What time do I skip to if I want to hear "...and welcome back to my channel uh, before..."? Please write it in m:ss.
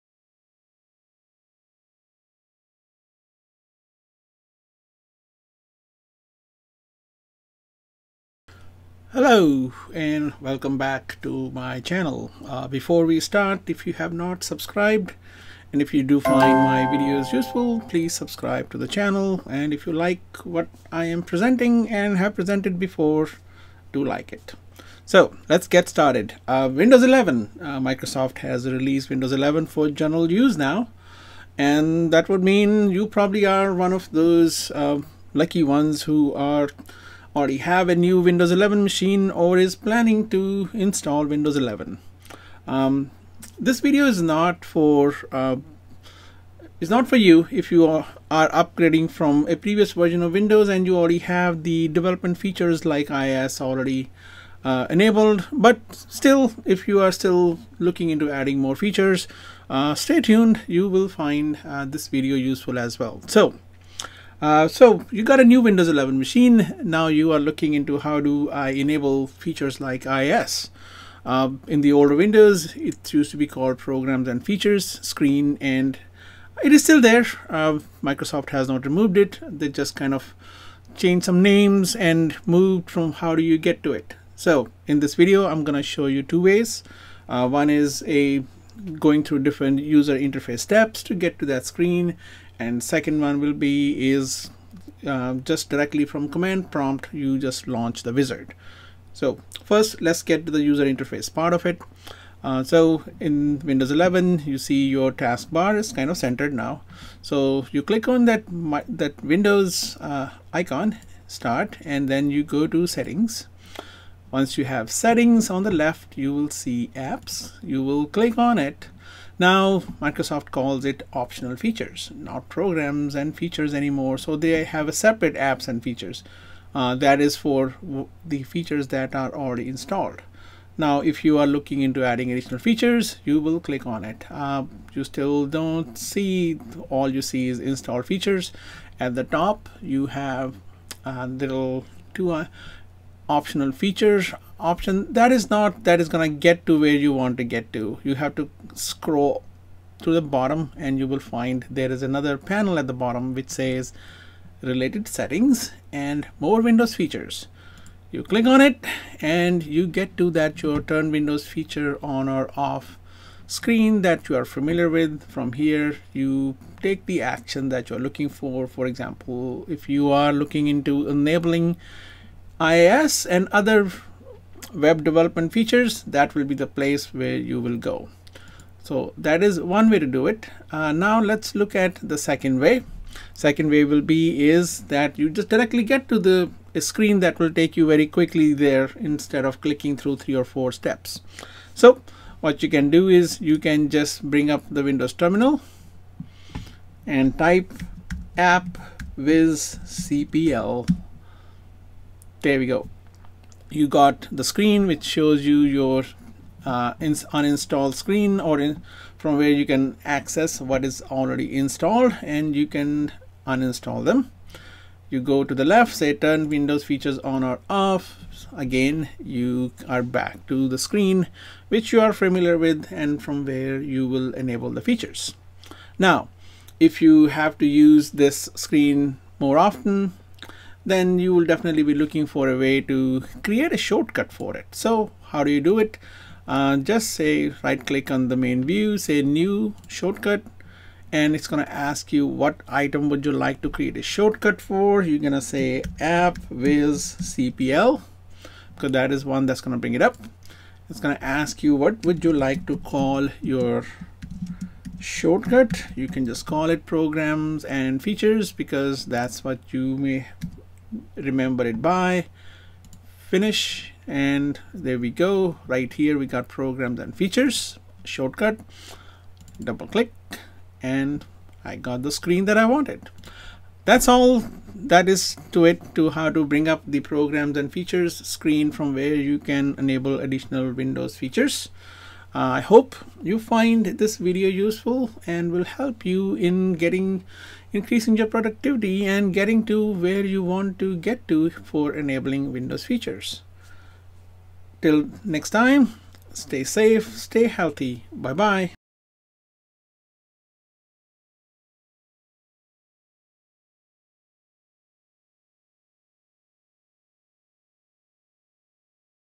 0:09.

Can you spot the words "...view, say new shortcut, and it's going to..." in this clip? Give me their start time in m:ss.
3:58.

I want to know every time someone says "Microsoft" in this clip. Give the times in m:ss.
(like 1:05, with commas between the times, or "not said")
0:27, 1:18, 1:59.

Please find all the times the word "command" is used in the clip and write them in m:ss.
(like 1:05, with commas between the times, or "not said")
1:36.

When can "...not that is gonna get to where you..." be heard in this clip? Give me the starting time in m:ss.
2:25.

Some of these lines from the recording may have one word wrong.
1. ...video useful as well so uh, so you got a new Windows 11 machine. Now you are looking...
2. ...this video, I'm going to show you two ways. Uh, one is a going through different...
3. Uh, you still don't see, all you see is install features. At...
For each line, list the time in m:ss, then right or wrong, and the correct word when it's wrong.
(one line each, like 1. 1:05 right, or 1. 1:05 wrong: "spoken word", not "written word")
1. 1:02 right
2. 1:25 right
3. 2:14 right.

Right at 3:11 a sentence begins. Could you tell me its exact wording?
So what you can do is you can just bring up the Windows terminal and type app viz cpl.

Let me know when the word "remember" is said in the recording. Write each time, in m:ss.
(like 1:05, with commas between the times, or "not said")
4:21.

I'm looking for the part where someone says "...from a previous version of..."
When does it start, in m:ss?
0:49.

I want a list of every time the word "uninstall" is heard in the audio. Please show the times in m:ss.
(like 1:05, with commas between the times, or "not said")
3:26, 3:33.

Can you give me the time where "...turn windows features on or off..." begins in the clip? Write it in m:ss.
3:36.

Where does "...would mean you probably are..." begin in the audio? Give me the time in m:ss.
0:32.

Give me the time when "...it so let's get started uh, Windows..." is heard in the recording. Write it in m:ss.
0:24.